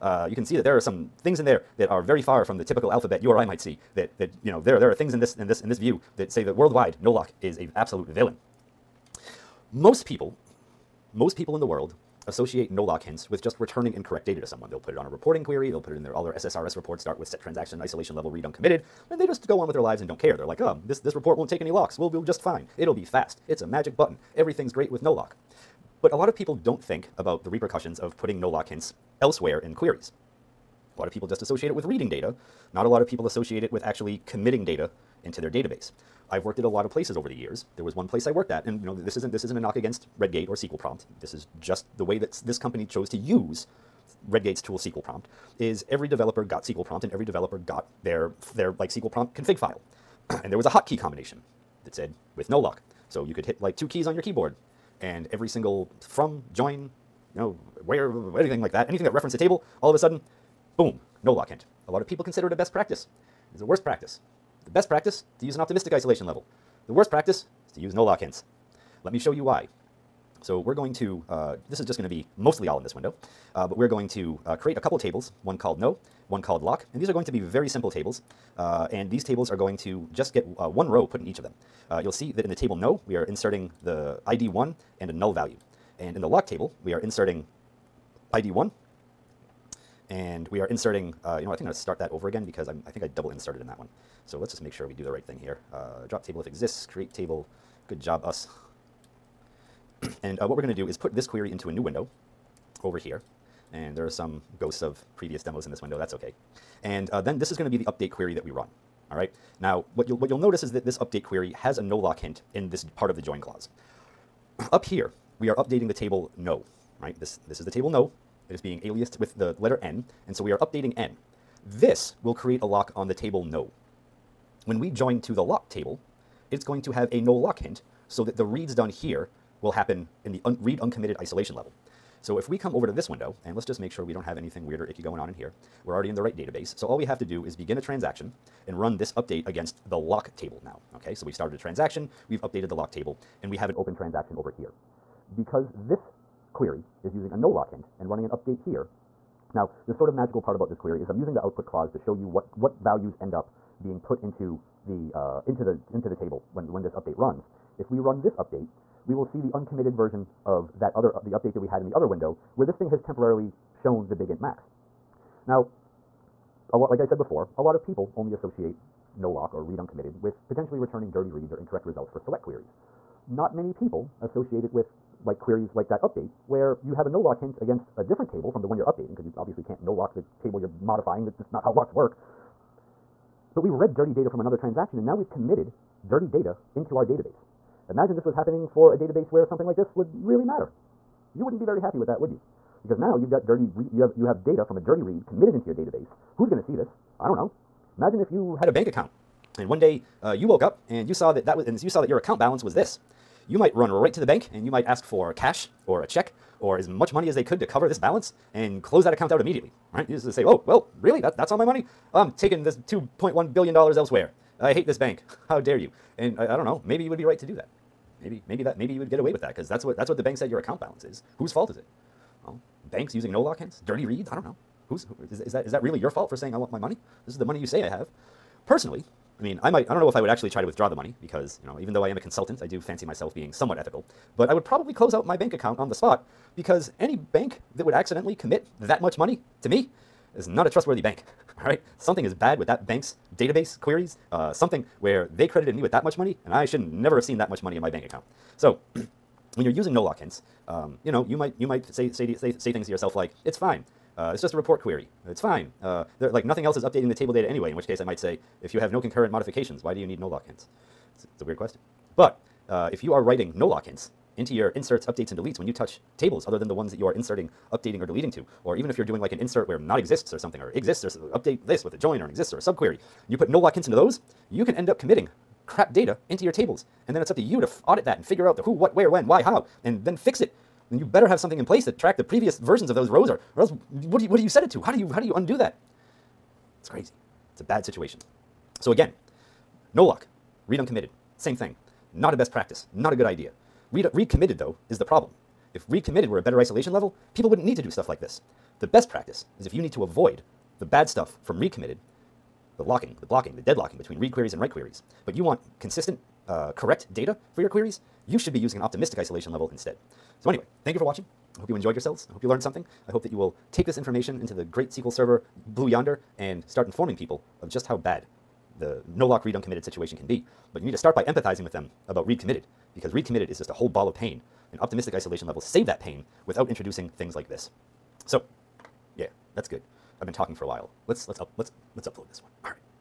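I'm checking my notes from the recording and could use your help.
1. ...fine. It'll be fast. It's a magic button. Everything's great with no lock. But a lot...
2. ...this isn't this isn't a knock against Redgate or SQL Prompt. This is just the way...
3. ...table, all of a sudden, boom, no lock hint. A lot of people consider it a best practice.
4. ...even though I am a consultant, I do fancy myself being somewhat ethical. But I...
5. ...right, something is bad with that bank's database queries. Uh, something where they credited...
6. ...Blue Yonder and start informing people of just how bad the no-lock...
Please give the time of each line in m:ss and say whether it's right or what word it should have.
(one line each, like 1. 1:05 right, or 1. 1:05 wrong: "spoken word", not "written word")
1. 0:22 right
2. 0:38 right
3. 0:59 right
4. 3:51 right
5. 4:01 right
6. 5:15 right.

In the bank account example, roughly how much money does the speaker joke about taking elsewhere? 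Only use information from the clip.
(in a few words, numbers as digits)
2.1 billion dollars.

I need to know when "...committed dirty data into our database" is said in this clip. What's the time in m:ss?
3:05.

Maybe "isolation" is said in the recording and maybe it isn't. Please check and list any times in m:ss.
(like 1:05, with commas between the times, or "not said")
0:17, 1:05, 2:11, 4:56, 5:09, 5:25.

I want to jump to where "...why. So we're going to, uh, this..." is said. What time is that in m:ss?
1:09.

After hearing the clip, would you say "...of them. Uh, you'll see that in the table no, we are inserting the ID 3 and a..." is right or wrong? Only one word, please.
wrong.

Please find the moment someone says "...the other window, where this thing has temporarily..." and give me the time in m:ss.
2:41.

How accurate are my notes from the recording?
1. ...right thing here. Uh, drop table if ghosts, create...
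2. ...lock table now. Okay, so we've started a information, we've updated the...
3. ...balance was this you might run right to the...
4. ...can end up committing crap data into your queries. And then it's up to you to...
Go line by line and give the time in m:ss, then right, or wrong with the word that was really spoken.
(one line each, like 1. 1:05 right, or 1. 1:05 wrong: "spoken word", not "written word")
1. 1:35 wrong: "exists", not "ghosts"
2. 2:19 wrong: "transaction", not "information"
3. 3:22 right
4. 4:34 wrong: "tables", not "queries".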